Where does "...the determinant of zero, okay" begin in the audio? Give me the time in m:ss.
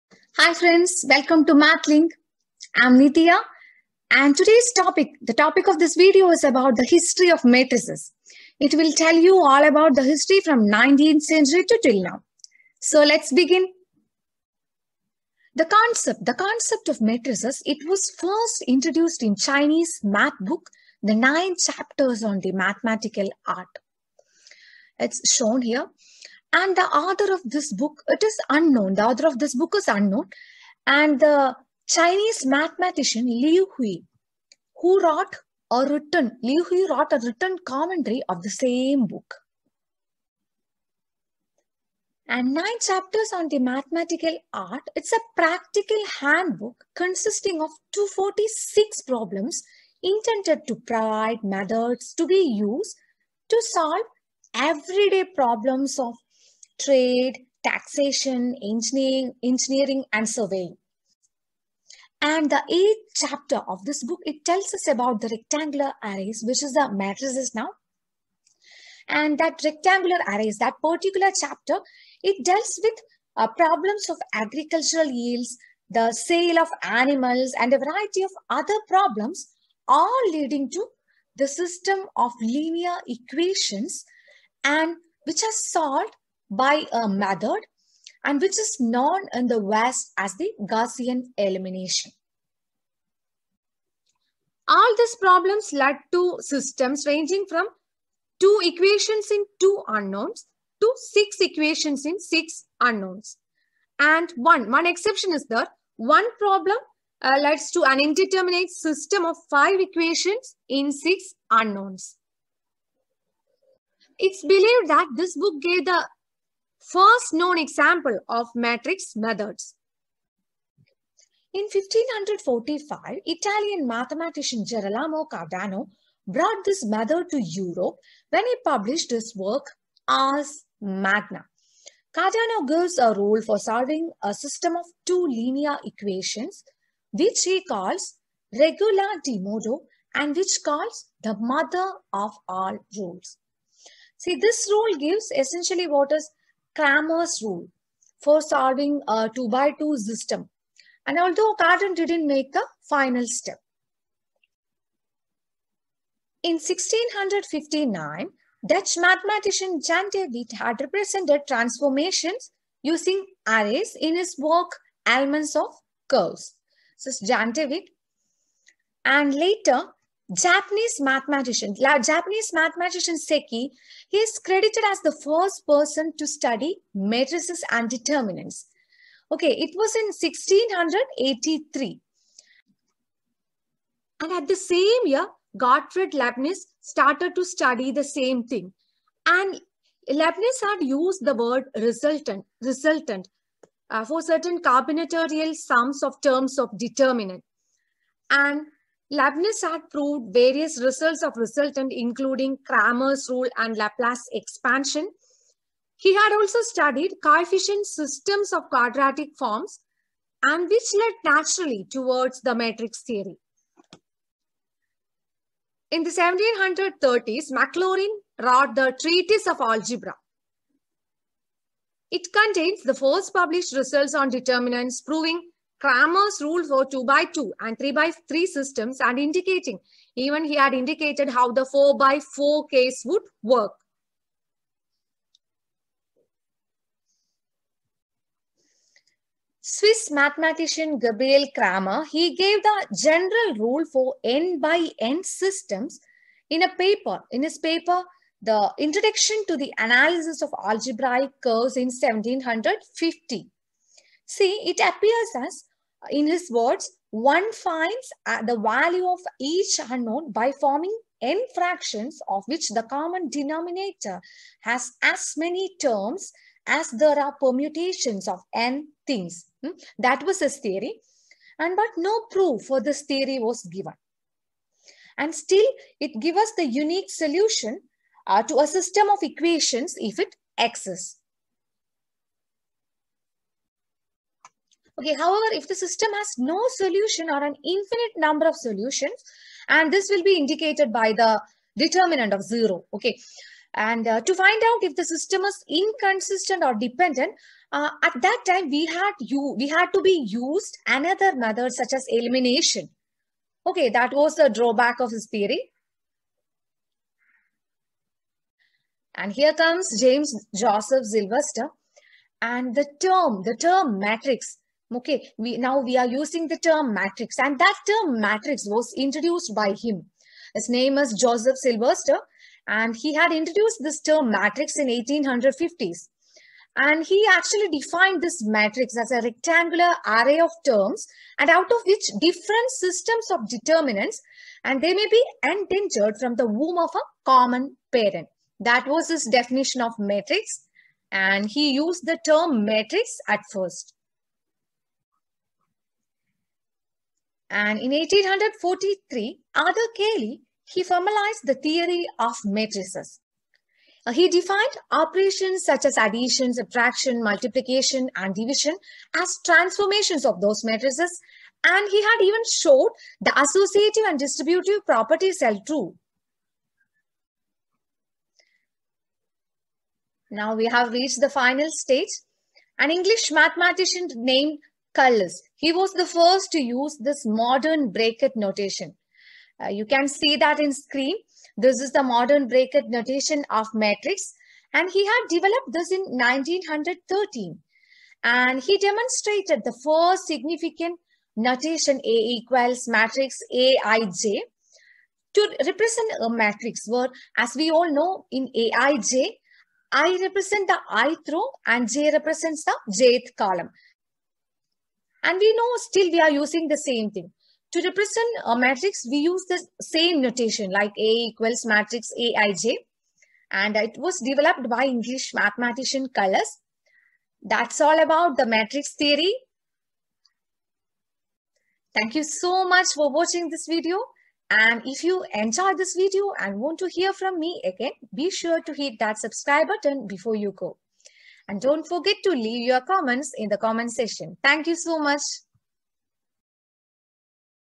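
4:51.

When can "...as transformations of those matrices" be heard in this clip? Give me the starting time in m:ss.
5:59.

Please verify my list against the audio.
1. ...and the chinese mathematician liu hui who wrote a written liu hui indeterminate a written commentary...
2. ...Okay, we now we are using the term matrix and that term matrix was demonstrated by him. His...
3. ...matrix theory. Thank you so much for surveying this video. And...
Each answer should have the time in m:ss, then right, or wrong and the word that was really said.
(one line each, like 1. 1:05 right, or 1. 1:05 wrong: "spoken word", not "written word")
1. 0:30 wrong: "wrote", not "indeterminate"
2. 5:14 wrong: "introduced", not "demonstrated"
3. 6:58 wrong: "watching", not "surveying".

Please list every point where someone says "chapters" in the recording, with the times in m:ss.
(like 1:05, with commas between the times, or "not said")
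0:21, 0:42, 1:03, 1:11.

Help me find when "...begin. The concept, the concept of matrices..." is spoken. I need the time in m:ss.
0:13.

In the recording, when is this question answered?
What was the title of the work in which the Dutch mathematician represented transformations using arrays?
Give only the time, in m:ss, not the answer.
2:45.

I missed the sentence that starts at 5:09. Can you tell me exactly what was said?
And here comes James Joseph Sylvester.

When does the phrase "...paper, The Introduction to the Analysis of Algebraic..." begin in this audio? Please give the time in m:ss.
4:07.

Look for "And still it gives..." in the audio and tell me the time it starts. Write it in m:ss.
4:35.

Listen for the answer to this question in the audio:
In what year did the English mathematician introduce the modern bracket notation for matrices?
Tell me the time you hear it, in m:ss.
6:26.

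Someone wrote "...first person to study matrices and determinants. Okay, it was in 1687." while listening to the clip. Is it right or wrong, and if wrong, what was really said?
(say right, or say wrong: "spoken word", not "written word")
wrong: "1683", not "1687".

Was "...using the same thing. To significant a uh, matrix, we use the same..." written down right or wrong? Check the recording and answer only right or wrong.
wrong.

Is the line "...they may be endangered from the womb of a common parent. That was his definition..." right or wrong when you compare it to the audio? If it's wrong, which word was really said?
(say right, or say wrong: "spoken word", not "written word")
right.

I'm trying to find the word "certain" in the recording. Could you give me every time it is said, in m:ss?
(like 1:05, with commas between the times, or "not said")
3:14.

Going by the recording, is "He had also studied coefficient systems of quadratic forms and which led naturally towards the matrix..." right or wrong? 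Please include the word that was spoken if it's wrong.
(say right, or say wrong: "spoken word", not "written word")
right.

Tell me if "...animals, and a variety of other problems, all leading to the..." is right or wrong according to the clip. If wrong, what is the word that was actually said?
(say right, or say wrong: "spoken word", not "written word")
right.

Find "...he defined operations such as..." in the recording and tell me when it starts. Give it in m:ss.
5:54.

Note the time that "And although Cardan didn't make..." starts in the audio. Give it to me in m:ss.
2:31.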